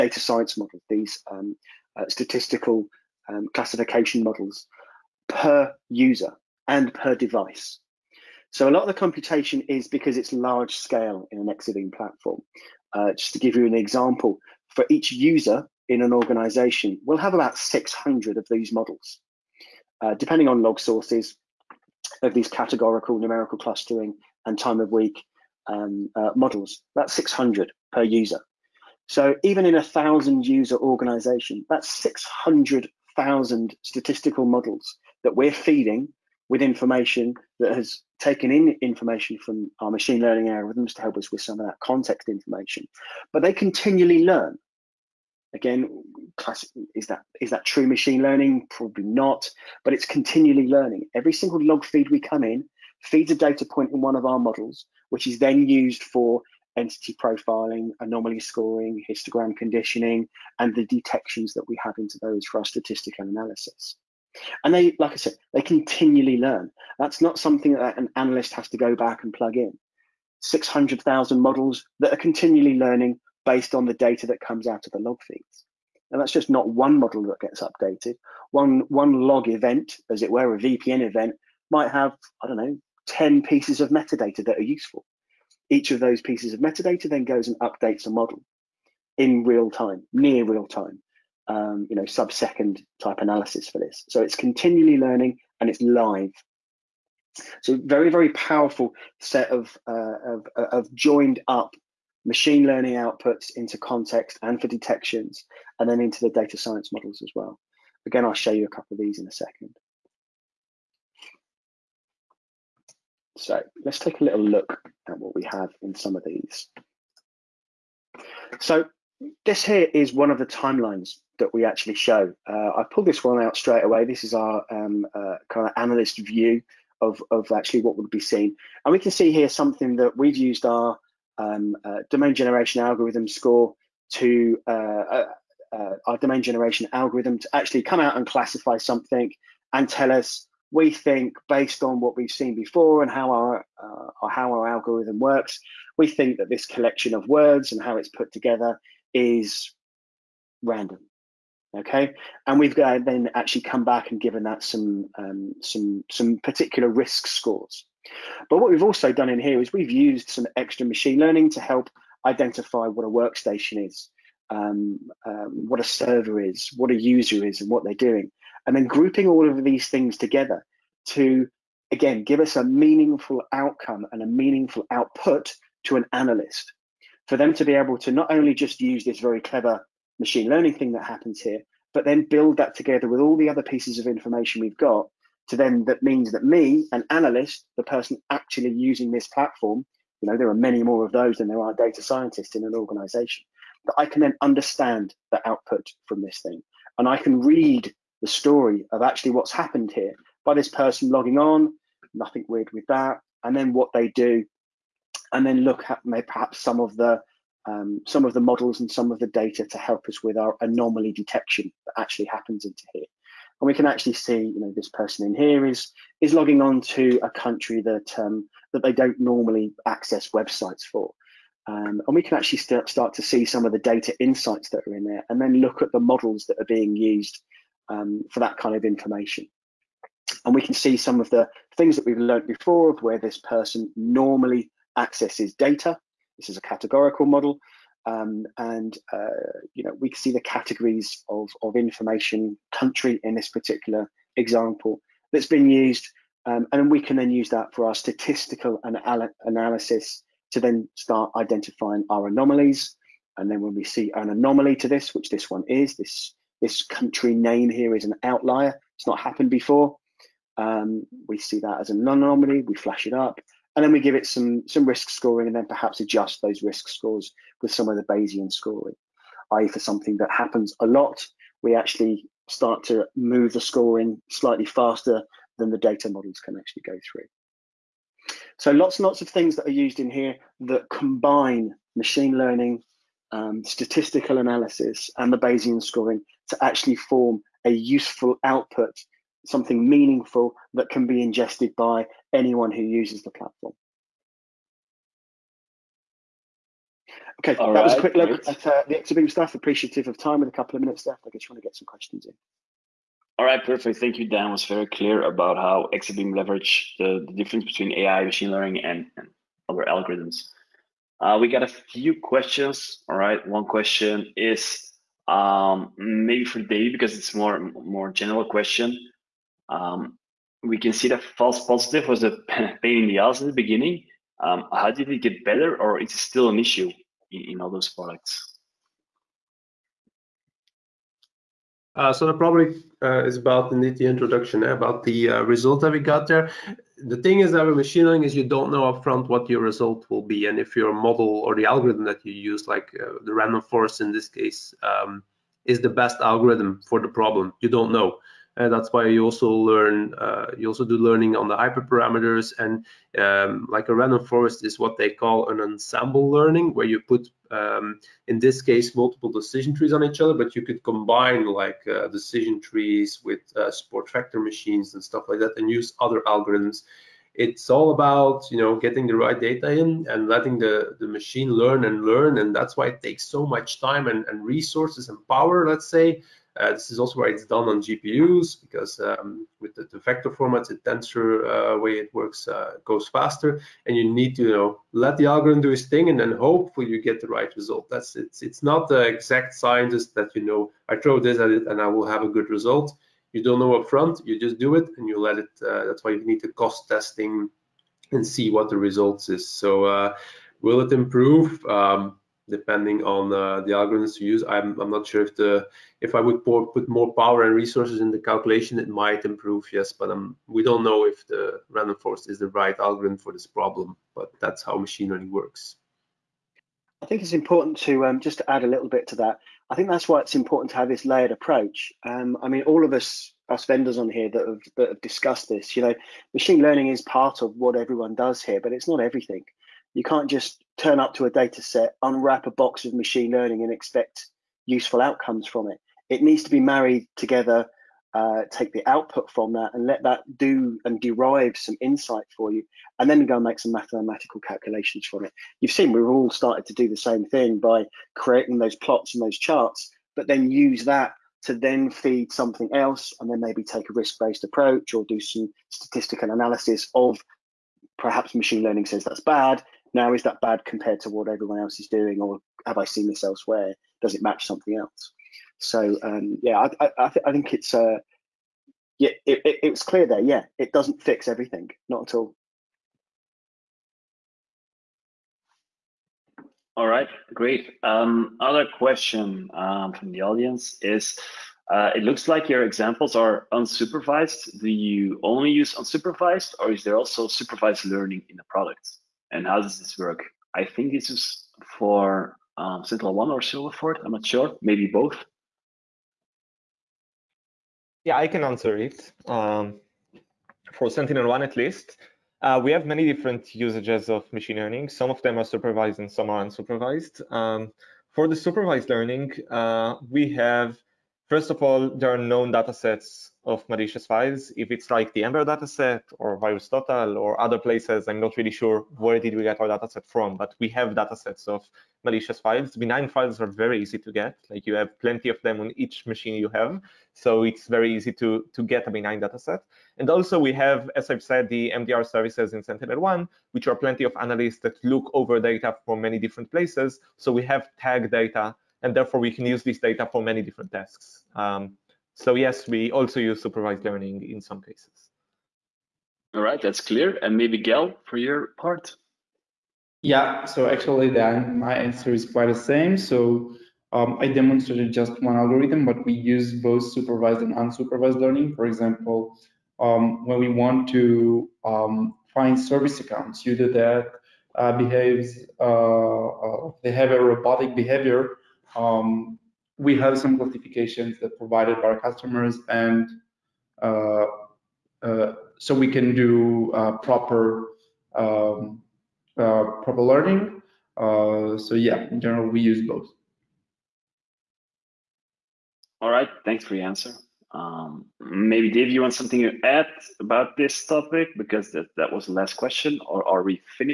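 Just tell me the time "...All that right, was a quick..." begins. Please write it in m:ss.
4:57.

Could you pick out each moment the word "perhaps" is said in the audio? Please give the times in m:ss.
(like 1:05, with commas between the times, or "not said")
3:26, 4:25, 7:37.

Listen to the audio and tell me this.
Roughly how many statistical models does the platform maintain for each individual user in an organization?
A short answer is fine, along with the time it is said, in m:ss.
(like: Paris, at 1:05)
600, at 0:17.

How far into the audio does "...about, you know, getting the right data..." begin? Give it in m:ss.
6:07.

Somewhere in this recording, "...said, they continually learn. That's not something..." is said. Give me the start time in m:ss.
1:05.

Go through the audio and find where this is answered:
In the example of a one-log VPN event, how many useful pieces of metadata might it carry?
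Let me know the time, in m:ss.
1:23.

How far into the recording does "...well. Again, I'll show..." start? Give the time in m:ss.
1:47.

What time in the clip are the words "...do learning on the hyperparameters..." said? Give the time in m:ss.
5:50.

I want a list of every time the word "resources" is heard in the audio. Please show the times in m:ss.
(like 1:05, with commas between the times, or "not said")
6:14, 6:47.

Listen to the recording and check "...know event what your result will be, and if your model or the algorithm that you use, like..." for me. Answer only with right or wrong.
wrong.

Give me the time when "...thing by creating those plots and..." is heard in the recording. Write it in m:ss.
7:27.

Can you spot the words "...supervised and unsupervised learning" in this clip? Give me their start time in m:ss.
9:16.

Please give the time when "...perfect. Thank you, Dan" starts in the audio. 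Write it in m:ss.
5:03.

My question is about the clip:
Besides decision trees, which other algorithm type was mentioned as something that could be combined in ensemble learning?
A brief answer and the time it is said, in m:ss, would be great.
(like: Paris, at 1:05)
Support vector machines, at 6:03.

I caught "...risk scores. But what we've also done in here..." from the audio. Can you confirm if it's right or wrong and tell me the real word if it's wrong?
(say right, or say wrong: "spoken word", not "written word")
right.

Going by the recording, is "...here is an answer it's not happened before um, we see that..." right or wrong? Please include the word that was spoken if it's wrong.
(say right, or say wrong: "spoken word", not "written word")
wrong: "outlier", not "answer".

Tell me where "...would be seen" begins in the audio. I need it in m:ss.
2:07.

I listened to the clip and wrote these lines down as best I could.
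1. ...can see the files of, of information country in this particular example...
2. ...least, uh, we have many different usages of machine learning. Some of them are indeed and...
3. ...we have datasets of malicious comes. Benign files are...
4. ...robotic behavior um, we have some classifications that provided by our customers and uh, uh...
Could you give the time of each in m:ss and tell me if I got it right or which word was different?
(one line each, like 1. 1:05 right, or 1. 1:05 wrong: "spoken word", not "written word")
1. 4:00 wrong: "categories", not "files"
2. 8:21 wrong: "supervised", not "indeed"
3. 8:40 wrong: "files", not "comes"
4. 9:27 right.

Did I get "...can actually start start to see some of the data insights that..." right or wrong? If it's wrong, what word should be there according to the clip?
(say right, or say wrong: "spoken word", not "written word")
right.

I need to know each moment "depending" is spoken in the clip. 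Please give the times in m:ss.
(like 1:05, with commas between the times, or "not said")
0:20, 6:42.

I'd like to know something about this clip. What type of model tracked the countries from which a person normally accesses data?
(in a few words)
Categorical model.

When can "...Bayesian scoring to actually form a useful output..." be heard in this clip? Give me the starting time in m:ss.
4:45.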